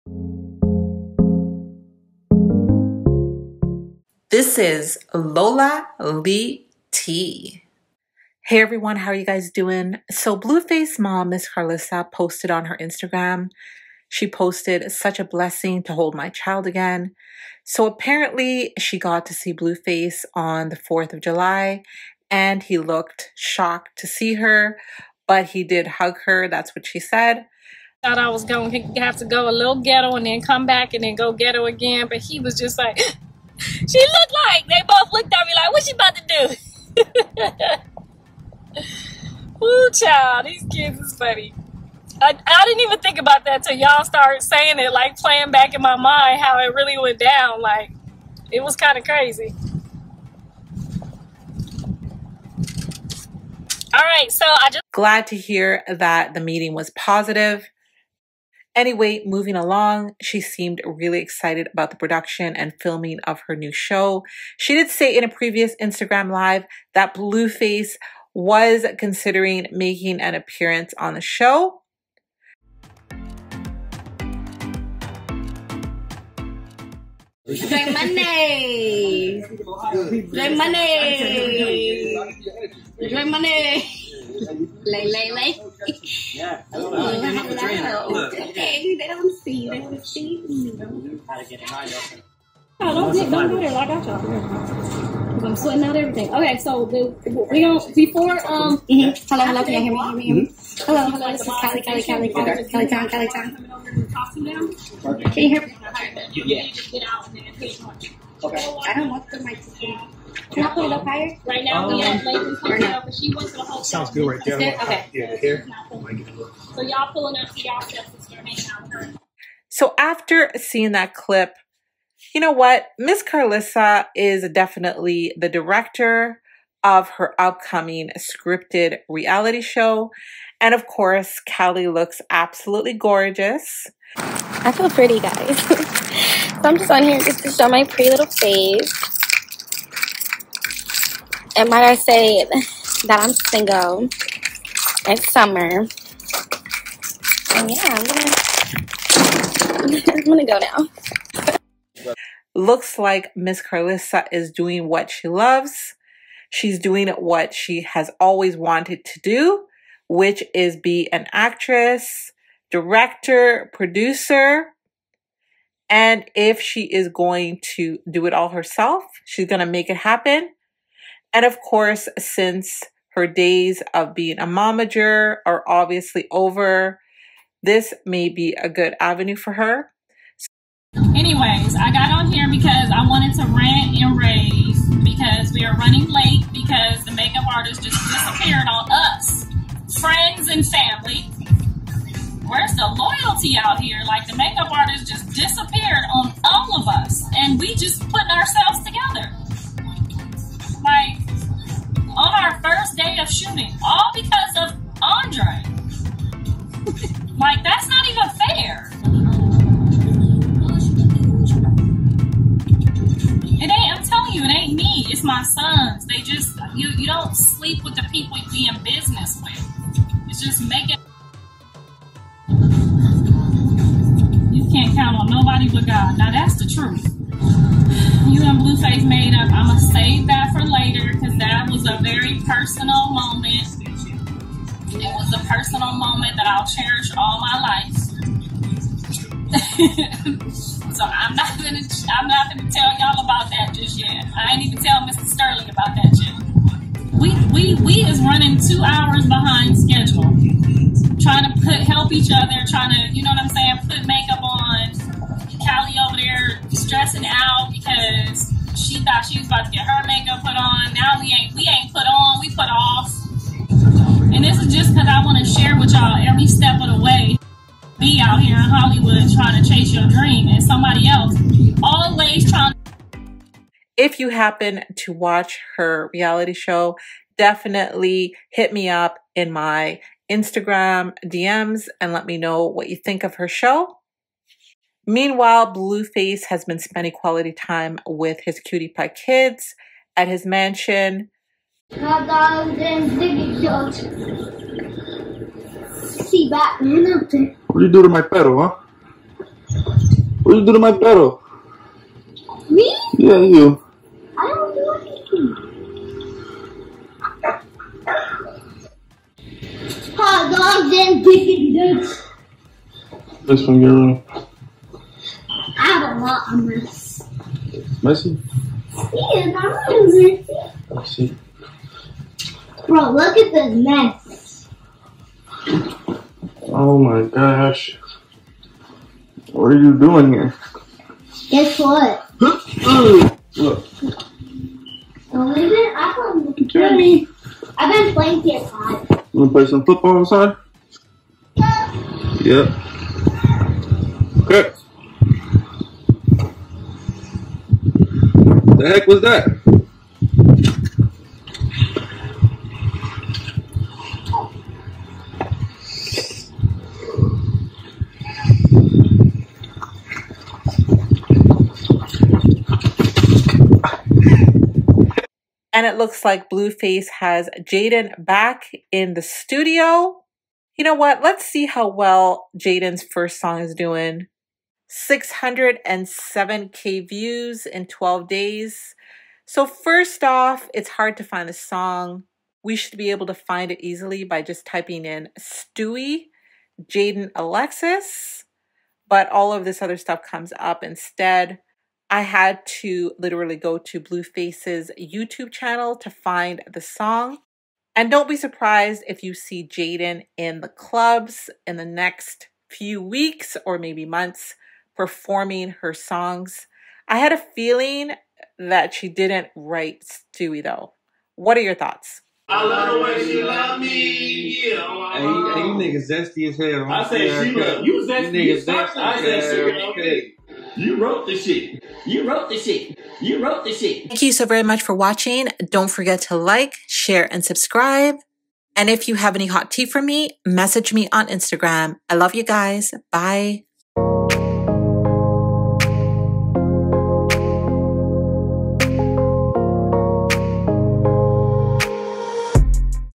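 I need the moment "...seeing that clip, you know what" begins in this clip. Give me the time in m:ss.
2:00.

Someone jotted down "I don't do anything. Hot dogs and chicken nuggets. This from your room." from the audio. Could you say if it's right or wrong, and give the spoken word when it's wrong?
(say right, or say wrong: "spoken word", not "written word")
right.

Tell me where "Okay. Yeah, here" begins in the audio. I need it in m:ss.
1:54.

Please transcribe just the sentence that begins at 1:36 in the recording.
Okay, so the, we don't before um.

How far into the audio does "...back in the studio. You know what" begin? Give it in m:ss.
6:08.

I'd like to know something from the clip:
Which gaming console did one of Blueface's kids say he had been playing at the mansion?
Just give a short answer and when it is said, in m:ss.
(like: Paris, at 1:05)
PS5, at 5:38.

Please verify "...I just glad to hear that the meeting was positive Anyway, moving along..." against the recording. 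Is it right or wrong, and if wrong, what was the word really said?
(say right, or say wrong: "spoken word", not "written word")
right.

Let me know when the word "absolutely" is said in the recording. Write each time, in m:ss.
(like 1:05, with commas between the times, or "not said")
2:12.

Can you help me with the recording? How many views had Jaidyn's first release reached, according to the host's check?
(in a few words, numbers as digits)
607k.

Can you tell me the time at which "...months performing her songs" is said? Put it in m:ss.
6:44.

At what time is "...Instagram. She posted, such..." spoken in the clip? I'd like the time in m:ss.
0:12.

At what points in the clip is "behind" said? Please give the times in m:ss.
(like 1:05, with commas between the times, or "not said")
4:09.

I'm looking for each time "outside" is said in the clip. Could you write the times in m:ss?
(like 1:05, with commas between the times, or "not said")
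5:40.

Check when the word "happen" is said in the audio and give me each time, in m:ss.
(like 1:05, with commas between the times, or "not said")
2:49, 4:34.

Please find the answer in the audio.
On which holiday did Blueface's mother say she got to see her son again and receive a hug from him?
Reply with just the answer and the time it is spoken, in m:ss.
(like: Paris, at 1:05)
4th of July, at 0:20.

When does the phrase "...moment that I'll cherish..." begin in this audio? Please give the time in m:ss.
3:55.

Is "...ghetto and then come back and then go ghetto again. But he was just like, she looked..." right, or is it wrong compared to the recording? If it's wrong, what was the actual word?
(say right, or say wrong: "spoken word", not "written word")
right.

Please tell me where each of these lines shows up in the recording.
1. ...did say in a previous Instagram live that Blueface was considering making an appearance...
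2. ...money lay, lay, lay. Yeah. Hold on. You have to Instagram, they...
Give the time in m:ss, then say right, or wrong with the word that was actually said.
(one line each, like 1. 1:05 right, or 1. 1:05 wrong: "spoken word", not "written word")
1. 1:04 right
2. 1:23 wrong: "Okay", not "Instagram".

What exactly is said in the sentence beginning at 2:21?
And might I say that I'm single.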